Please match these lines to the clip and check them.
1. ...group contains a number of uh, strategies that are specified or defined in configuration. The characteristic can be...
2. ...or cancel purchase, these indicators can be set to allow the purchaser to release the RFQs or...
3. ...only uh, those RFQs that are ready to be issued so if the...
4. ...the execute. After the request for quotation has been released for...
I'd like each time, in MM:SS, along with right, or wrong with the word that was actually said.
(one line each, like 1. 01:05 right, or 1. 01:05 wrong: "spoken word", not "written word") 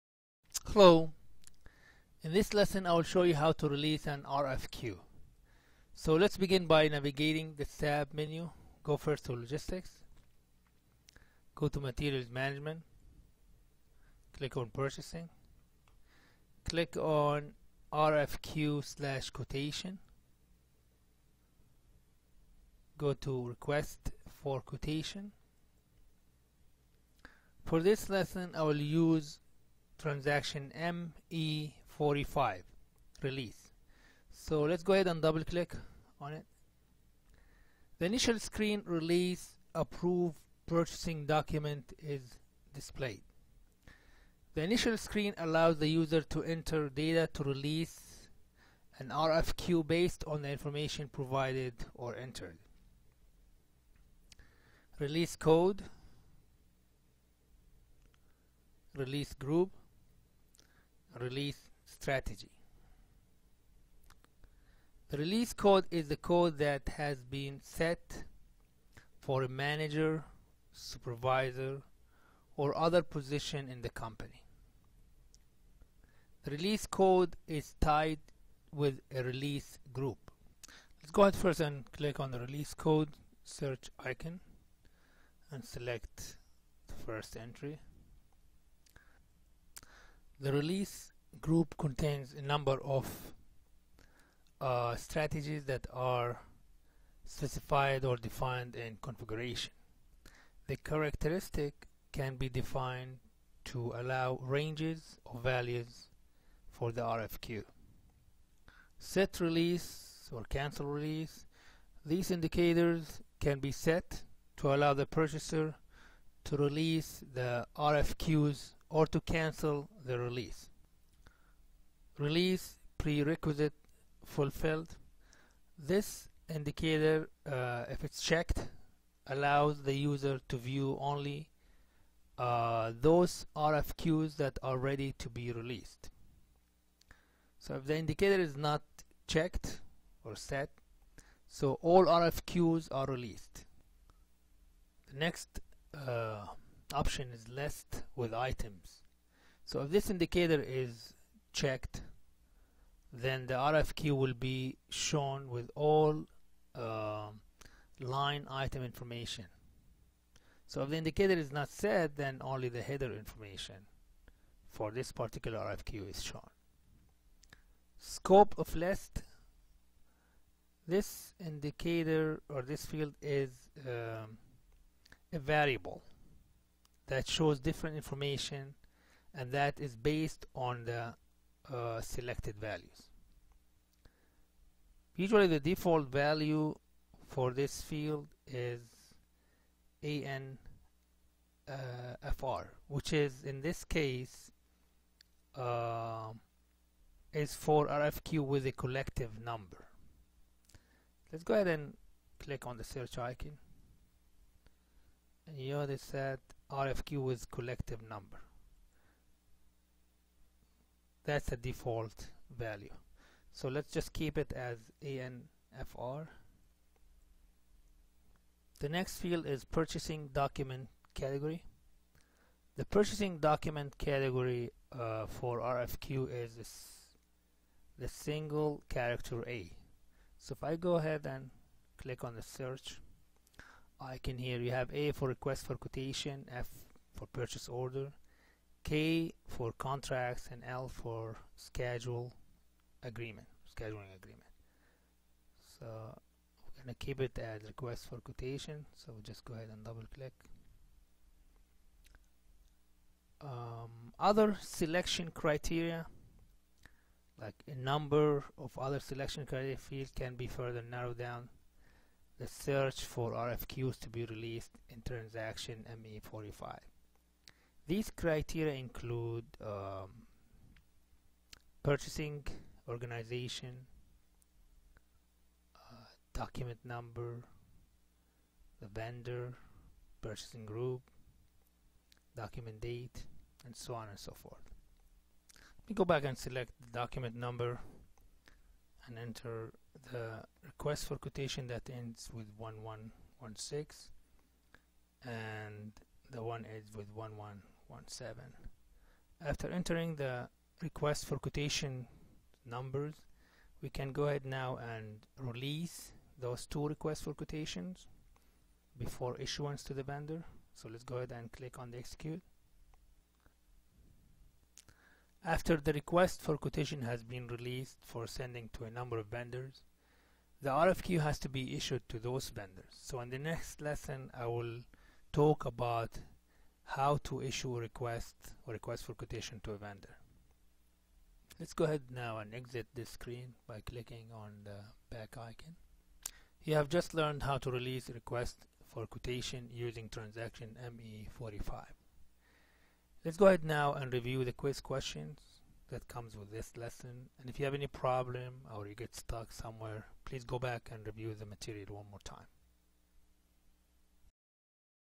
1. 01:31 right
2. 01:50 wrong: "release", not "purchase"
3. 02:11 wrong: "released", not "issued"
4. 05:11 right.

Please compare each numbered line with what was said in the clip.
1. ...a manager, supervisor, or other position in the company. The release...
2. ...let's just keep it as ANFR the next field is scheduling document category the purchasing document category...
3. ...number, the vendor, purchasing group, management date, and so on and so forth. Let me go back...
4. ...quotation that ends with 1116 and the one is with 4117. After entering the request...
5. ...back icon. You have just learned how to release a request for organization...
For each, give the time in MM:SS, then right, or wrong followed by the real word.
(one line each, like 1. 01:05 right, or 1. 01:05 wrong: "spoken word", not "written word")
1. 01:09 right
2. 03:33 wrong: "purchasing", not "scheduling"
3. 04:36 wrong: "document", not "management"
4. 04:51 wrong: "1117", not "4117"
5. 05:35 wrong: "quotation", not "organization".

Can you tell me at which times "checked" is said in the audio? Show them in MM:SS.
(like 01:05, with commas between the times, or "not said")
02:08, 02:19, 02:31.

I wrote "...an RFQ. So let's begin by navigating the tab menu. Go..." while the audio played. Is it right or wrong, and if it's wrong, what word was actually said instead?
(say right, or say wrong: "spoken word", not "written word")
right.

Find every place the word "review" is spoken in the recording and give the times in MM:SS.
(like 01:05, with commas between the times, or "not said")
05:44, 05:51.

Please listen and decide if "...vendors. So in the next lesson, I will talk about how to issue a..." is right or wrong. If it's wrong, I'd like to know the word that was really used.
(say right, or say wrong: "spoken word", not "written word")
right.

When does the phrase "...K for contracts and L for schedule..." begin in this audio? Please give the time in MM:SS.
03:58.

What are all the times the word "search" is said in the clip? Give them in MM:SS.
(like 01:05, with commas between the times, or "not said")
01:23, 03:22, 03:52, 04:22.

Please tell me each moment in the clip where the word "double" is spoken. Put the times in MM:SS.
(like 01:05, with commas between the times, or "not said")
00:35, 04:09.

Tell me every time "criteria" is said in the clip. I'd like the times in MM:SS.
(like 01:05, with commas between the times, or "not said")
04:15, 04:19, 04:28.